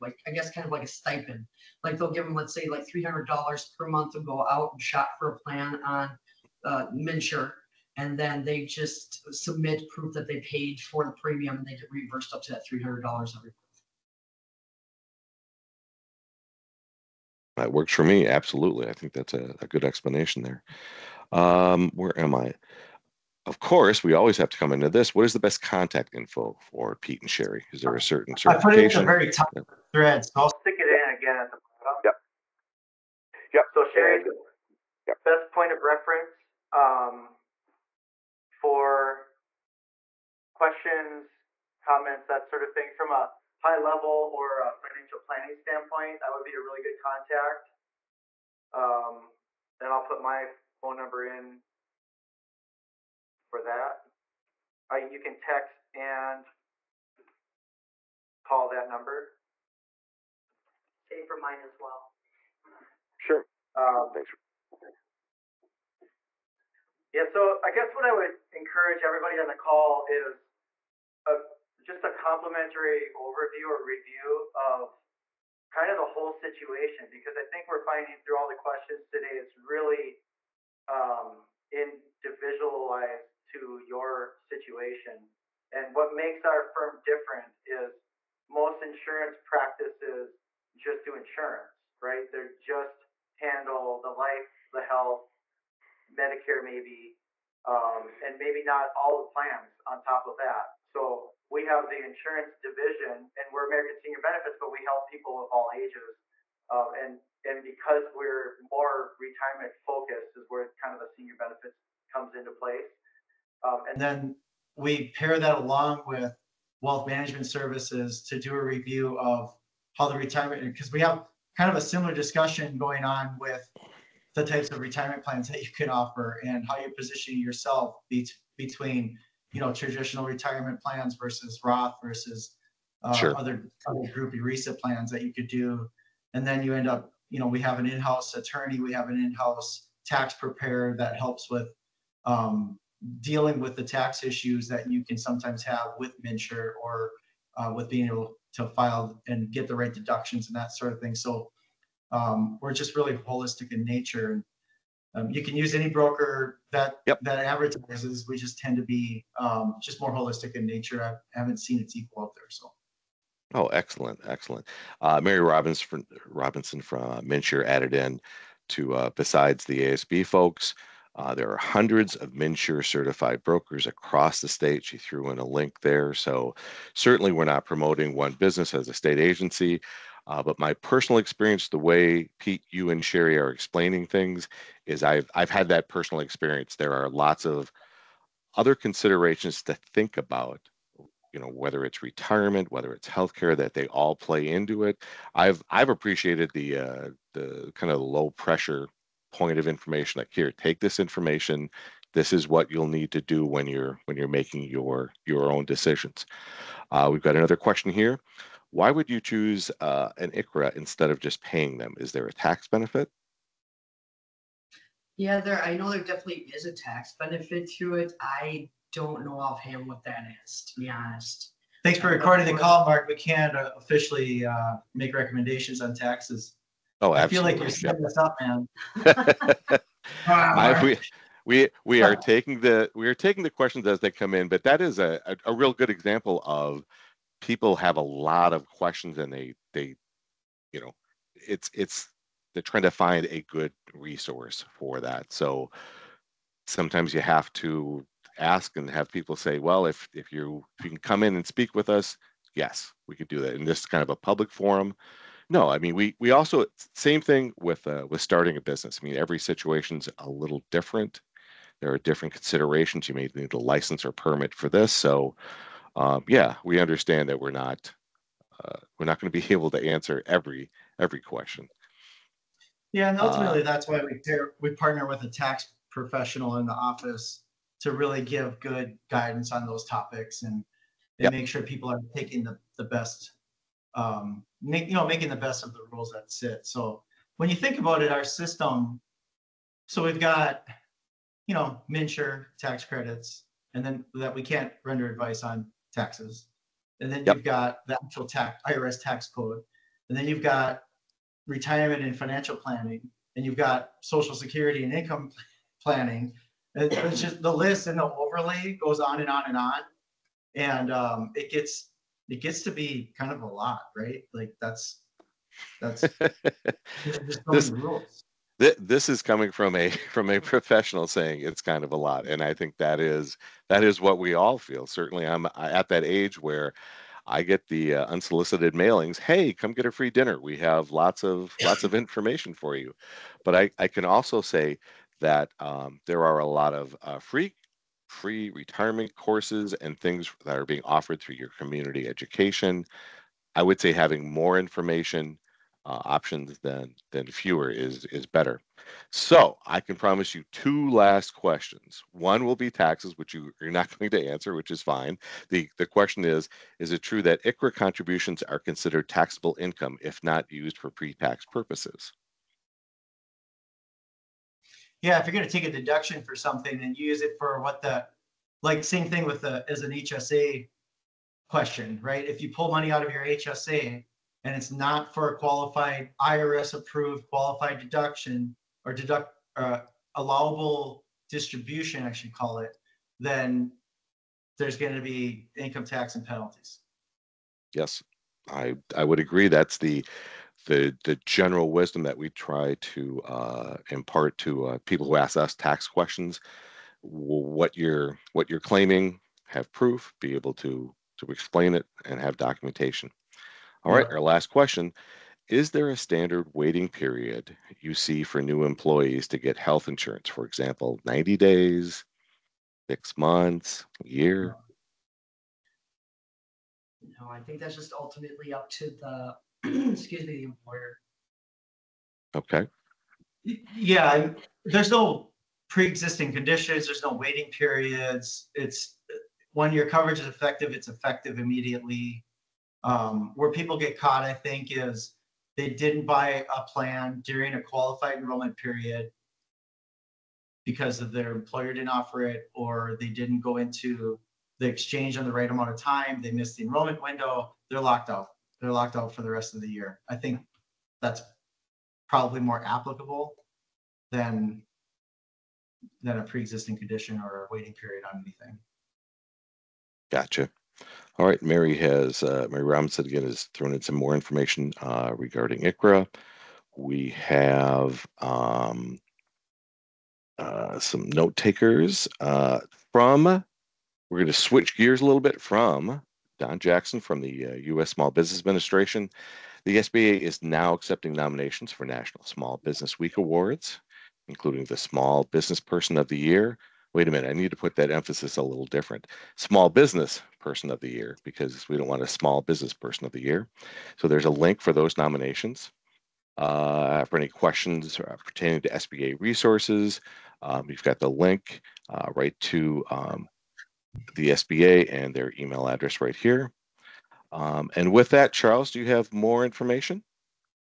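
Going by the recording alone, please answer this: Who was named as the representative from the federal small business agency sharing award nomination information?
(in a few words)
Don Jackson.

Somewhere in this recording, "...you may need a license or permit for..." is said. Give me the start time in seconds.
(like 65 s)
263 s.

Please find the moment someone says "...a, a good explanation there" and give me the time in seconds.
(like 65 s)
19 s.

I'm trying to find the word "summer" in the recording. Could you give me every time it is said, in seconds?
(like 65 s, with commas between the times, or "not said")
not said.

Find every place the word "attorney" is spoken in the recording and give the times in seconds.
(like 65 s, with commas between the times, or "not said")
138 s.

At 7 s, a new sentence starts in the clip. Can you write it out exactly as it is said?
And then they just submit proof that they paid for the premium and they get reimbursed up to that $300 every month.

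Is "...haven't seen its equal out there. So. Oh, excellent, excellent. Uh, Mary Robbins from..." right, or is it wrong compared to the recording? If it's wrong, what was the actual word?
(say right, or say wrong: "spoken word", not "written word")
right.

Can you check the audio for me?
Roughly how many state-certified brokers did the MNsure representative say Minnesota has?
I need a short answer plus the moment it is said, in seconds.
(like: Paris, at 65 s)
hundreds, at 171 s.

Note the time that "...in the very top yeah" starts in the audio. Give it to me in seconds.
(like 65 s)
28 s.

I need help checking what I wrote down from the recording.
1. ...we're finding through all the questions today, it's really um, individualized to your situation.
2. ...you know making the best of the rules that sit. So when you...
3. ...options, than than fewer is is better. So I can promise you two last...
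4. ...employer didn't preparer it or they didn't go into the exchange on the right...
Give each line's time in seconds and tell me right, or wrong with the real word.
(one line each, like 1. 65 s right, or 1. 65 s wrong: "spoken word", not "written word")
1. 77 s right
2. 284 s right
3. 346 s right
4. 441 s wrong: "offer", not "preparer".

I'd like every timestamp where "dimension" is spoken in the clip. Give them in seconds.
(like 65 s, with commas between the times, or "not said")
not said.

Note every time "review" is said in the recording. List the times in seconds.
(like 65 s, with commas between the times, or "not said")
73 s, 118 s.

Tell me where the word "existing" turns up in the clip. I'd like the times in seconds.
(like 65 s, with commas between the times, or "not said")
425 s, 456 s.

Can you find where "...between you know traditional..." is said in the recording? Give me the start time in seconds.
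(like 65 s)
128 s.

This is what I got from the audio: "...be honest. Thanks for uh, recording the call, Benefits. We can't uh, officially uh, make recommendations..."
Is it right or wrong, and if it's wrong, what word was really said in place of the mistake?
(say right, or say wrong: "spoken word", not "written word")
wrong: "Mark", not "Benefits".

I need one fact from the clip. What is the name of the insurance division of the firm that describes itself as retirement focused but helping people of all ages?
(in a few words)
American Senior Benefits.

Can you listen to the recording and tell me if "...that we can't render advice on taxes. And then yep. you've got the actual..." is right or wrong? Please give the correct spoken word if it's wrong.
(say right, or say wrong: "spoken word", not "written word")
right.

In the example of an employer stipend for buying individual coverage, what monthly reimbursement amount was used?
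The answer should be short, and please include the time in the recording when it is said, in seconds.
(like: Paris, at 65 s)
$300, at 2 s.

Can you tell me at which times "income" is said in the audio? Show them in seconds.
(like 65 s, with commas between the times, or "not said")
304 s, 359 s, 385 s.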